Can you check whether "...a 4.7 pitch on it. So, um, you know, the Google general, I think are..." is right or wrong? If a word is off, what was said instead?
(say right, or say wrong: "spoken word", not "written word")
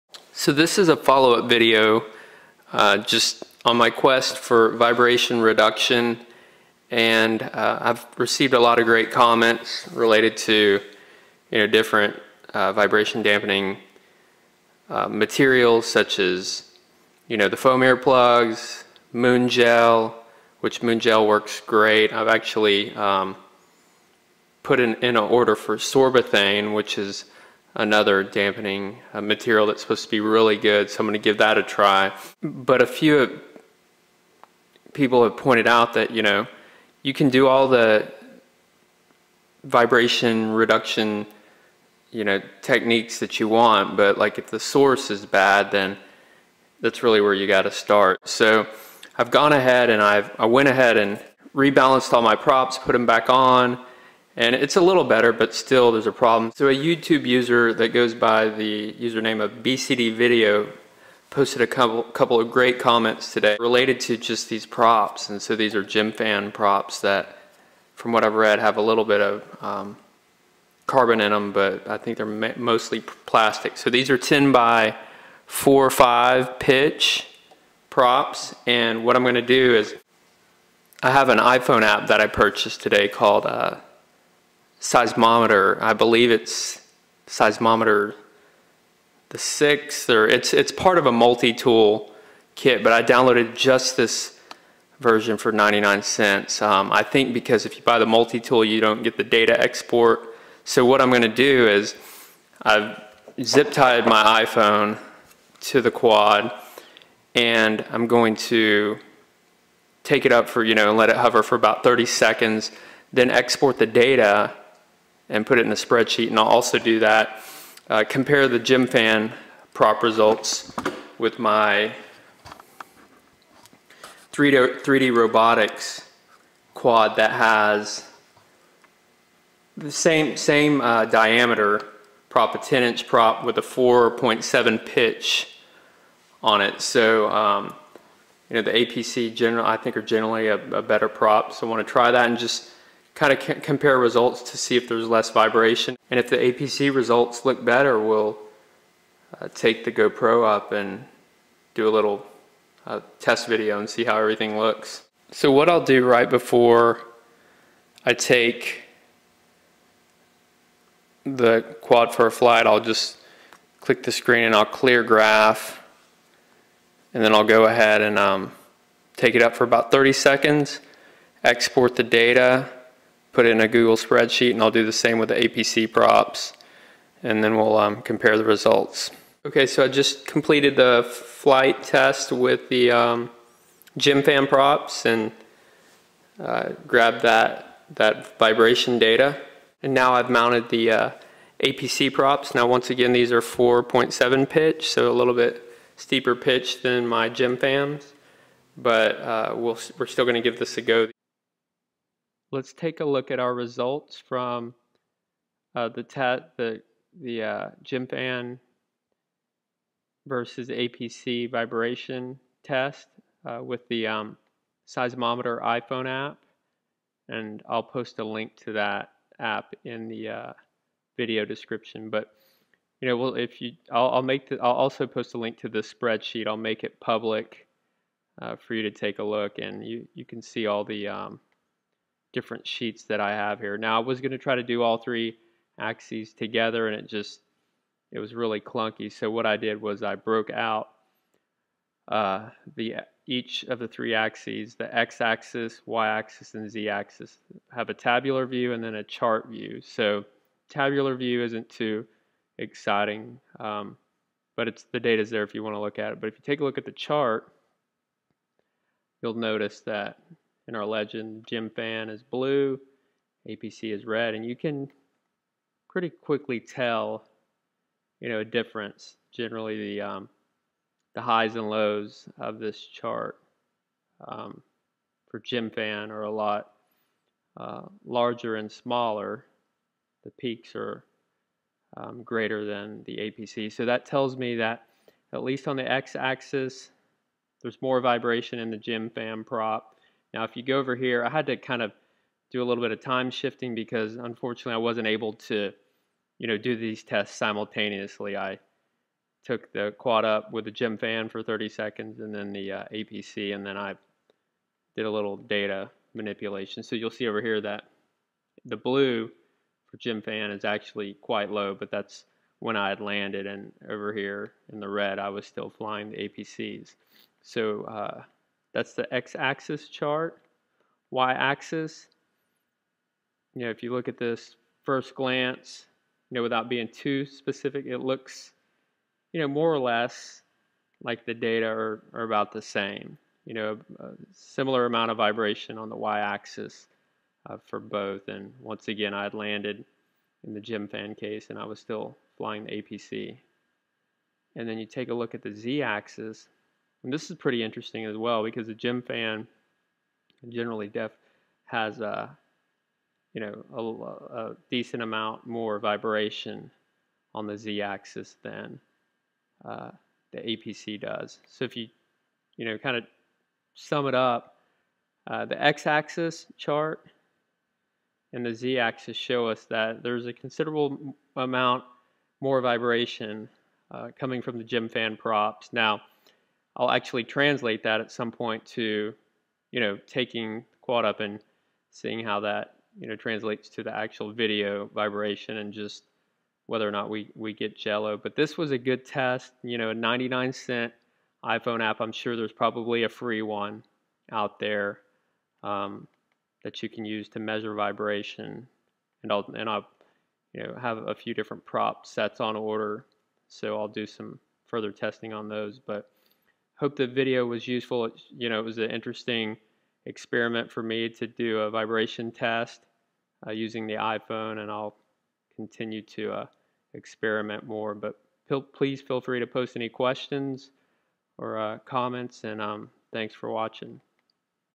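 wrong: "APC", not "Google".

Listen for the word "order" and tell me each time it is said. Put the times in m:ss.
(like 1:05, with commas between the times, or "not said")
0:25, 6:42.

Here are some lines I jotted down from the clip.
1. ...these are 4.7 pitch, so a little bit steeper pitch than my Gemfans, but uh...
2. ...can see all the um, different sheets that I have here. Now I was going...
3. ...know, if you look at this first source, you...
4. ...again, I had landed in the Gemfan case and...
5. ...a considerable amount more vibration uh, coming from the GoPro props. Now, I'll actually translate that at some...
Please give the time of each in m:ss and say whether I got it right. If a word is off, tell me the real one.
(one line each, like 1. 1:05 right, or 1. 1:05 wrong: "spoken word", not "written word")
1. 3:13 right
2. 3:50 right
3. 5:23 wrong: "glance", not "source"
4. 5:38 right
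5. 6:10 wrong: "Gemfan", not "GoPro".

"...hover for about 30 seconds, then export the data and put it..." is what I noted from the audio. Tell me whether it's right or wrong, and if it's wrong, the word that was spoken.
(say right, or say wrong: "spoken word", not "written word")
right.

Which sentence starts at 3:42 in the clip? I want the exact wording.
But you know, well, if you, I'll, I'll make the, I'll also post a link to the spreadsheet.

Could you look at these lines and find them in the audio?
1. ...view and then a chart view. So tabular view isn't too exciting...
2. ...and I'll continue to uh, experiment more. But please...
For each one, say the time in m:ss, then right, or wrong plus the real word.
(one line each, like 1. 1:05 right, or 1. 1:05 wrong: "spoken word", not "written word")
1. 4:08 right
2. 6:54 right.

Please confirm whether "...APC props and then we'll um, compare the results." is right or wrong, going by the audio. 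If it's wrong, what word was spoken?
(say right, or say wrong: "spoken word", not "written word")
right.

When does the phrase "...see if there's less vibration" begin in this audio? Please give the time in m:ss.
2:24.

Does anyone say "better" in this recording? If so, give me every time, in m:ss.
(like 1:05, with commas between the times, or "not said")
0:55, 2:20, 2:27.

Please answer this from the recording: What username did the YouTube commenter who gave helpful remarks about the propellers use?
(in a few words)
BCD Video.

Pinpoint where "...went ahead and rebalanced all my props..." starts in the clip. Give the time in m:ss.
0:50.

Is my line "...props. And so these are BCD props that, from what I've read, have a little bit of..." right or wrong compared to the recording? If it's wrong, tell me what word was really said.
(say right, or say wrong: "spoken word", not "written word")
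wrong: "Gemfan", not "BCD".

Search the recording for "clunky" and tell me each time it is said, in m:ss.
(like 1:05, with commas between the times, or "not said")
3:58.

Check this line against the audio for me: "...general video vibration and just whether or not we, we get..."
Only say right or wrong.
wrong.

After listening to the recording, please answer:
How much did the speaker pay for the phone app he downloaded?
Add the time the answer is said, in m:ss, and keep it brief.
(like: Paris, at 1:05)
99 cents, at 1:35.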